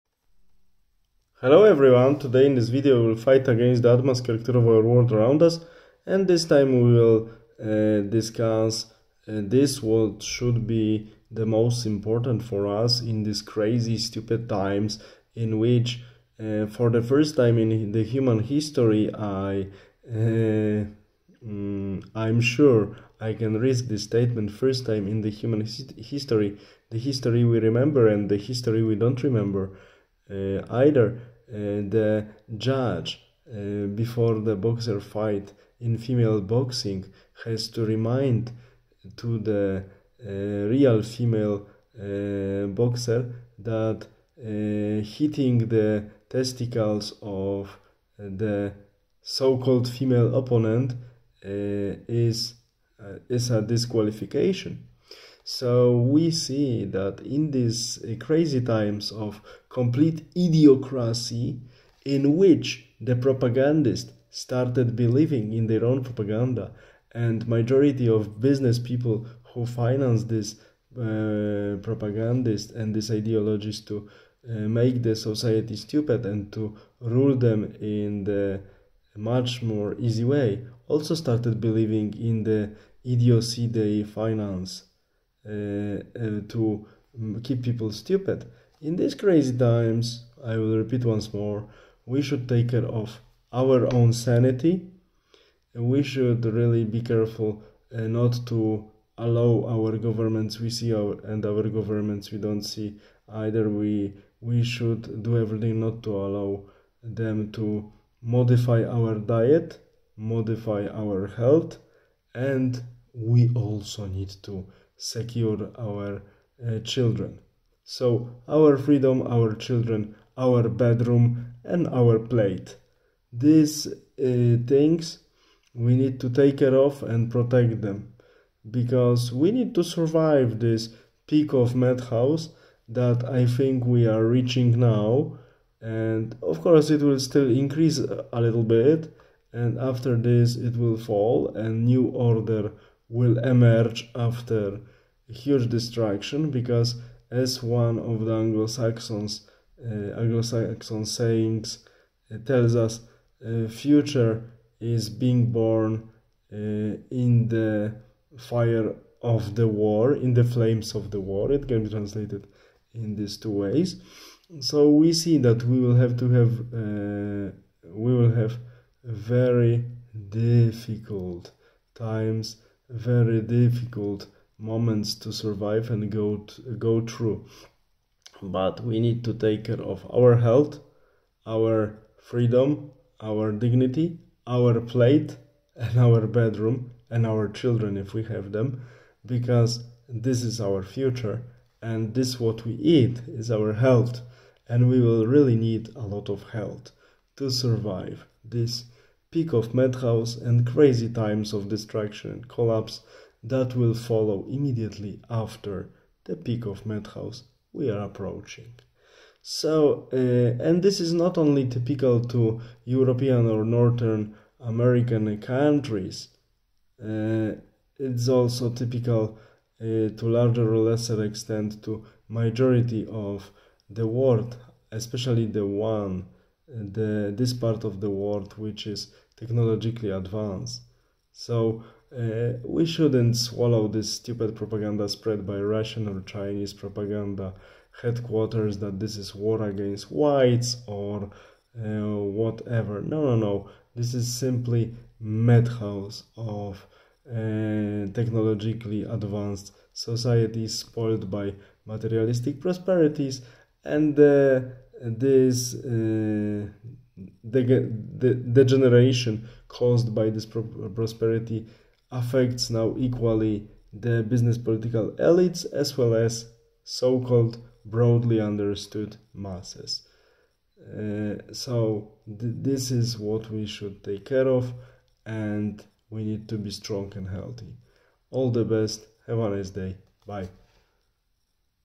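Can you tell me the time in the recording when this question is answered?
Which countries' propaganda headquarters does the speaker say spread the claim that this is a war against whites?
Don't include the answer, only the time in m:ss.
3:55.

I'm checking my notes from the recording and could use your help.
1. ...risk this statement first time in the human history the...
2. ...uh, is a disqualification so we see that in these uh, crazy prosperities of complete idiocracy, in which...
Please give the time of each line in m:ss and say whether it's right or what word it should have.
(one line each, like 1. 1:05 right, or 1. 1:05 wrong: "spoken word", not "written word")
1. 0:23 right
2. 0:53 wrong: "times", not "prosperities".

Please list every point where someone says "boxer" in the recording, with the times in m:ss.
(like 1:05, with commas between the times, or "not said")
0:34, 0:42.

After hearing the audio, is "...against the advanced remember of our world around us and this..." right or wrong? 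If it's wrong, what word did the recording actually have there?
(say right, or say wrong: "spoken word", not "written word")
wrong: "character", not "remember".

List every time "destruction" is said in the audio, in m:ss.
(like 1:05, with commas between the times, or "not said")
2:25, 3:21.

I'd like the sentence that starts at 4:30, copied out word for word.
Uh, so th this is what we should take care of and we need to be strong and healthy.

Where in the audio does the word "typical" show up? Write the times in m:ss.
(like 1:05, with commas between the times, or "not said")
3:31, 3:38.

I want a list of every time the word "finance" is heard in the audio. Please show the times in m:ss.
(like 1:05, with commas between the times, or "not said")
1:09, 1:24.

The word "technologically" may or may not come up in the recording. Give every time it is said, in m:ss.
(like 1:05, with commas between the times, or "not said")
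3:49, 4:08.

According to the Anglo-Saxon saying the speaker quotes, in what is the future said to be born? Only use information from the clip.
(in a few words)
The fire of the war.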